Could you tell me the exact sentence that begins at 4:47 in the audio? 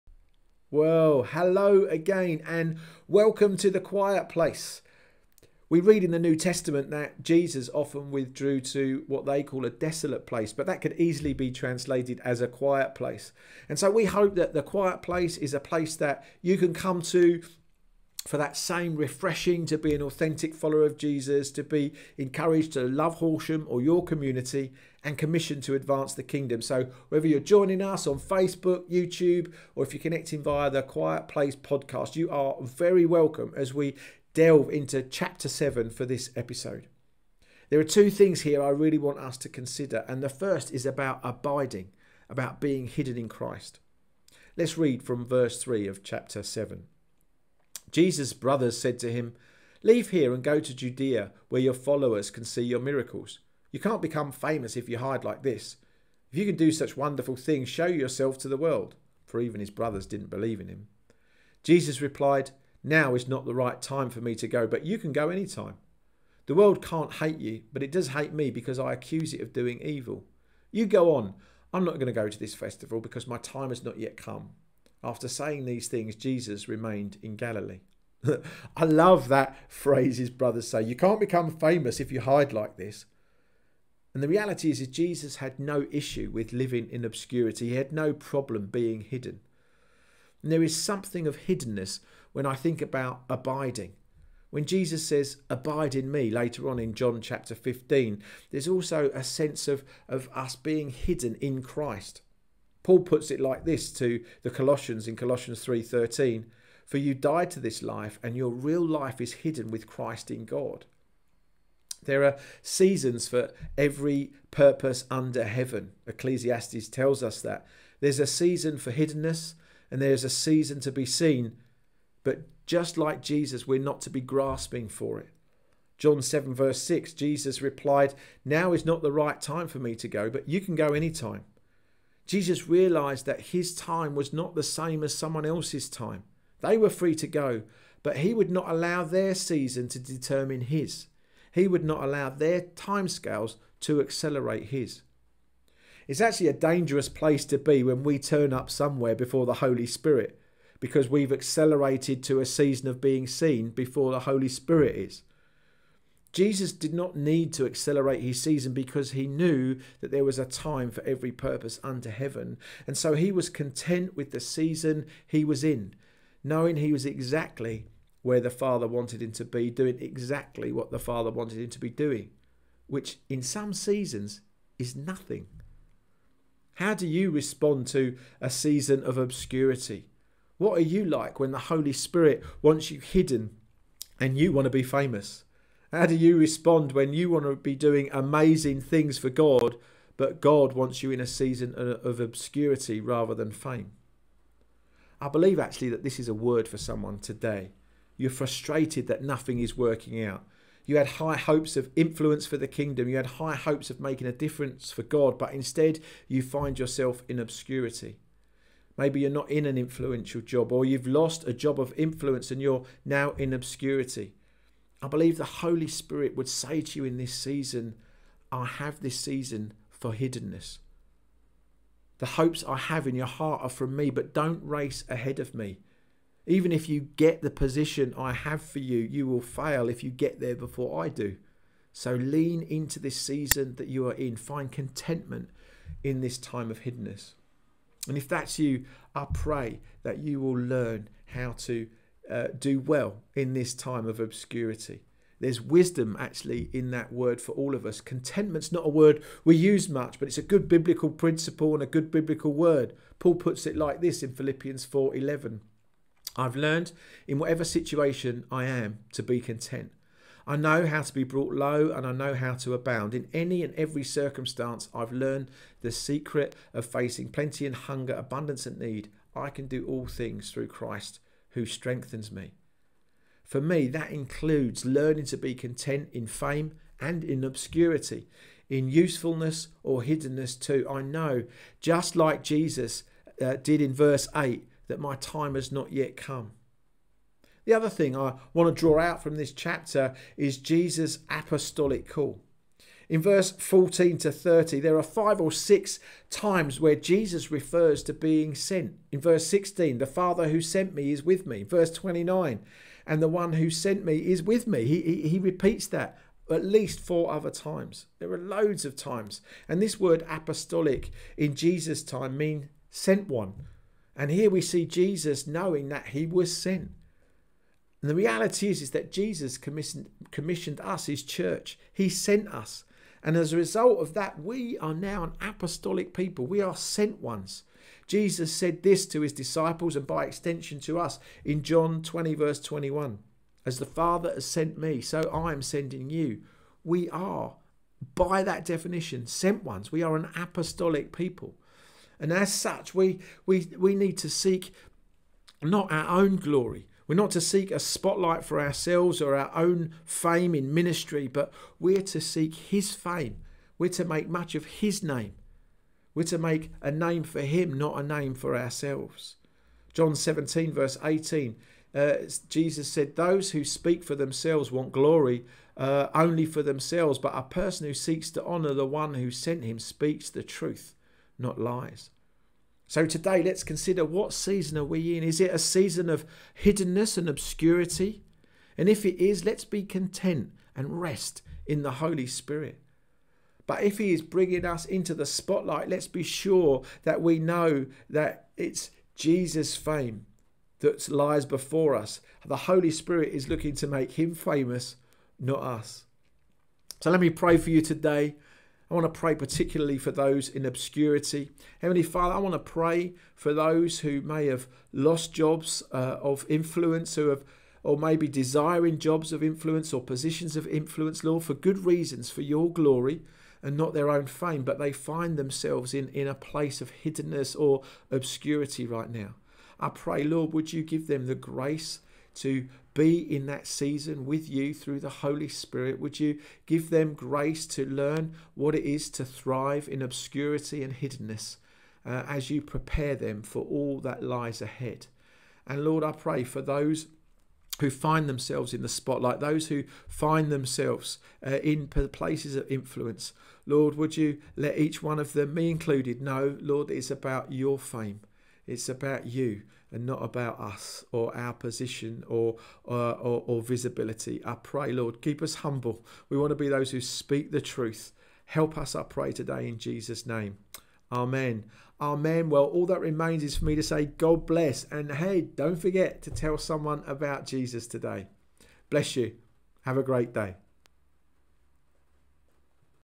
The other thing I want to draw out from this chapter is Jesus' apostolic call.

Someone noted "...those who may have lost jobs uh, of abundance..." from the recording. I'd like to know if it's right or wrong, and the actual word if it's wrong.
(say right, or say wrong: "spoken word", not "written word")
wrong: "influence", not "abundance".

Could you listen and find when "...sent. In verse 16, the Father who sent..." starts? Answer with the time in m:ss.
4:58.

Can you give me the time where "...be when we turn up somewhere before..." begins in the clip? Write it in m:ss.
2:27.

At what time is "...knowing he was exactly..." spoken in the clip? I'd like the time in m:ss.
2:46.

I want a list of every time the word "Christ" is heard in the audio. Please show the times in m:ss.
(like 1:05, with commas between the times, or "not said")
0:43, 1:41, 1:49, 4:30.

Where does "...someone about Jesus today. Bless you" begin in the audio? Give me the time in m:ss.
7:46.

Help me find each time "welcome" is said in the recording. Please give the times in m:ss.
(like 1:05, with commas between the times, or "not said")
0:03, 0:33.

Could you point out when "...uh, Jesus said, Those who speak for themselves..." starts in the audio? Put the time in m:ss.
6:01.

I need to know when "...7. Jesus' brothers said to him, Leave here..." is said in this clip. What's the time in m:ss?
0:46.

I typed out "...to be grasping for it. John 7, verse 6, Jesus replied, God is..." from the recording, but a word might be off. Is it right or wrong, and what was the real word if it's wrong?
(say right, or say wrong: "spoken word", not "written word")
wrong: "Now", not "God".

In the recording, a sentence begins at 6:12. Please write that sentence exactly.
So today, let's consider what season are we in?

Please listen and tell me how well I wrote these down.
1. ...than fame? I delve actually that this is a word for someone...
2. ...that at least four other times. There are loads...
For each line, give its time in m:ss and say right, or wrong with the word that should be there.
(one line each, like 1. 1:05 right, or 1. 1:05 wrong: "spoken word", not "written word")
1. 3:13 wrong: "believe", not "delve"
2. 5:05 right.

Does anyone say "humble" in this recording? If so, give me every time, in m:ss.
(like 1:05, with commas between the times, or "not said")
7:35.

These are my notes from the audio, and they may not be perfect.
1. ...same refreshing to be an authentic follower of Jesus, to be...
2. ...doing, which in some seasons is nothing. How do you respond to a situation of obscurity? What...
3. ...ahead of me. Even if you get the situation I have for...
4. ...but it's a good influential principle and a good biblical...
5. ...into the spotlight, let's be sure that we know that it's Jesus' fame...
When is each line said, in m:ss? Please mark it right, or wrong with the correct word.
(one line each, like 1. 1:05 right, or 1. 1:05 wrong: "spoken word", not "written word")
1. 0:18 right
2. 2:51 wrong: "season", not "situation"
3. 3:45 wrong: "position", not "situation"
4. 4:10 wrong: "biblical", not "influential"
5. 6:24 right.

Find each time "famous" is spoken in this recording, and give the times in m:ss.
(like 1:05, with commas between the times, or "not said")
0:54, 1:21, 3:04, 6:34.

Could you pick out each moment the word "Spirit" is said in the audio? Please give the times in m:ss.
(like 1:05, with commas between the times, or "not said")
2:29, 2:34, 3:01, 3:35, 6:22, 6:32, 7:05.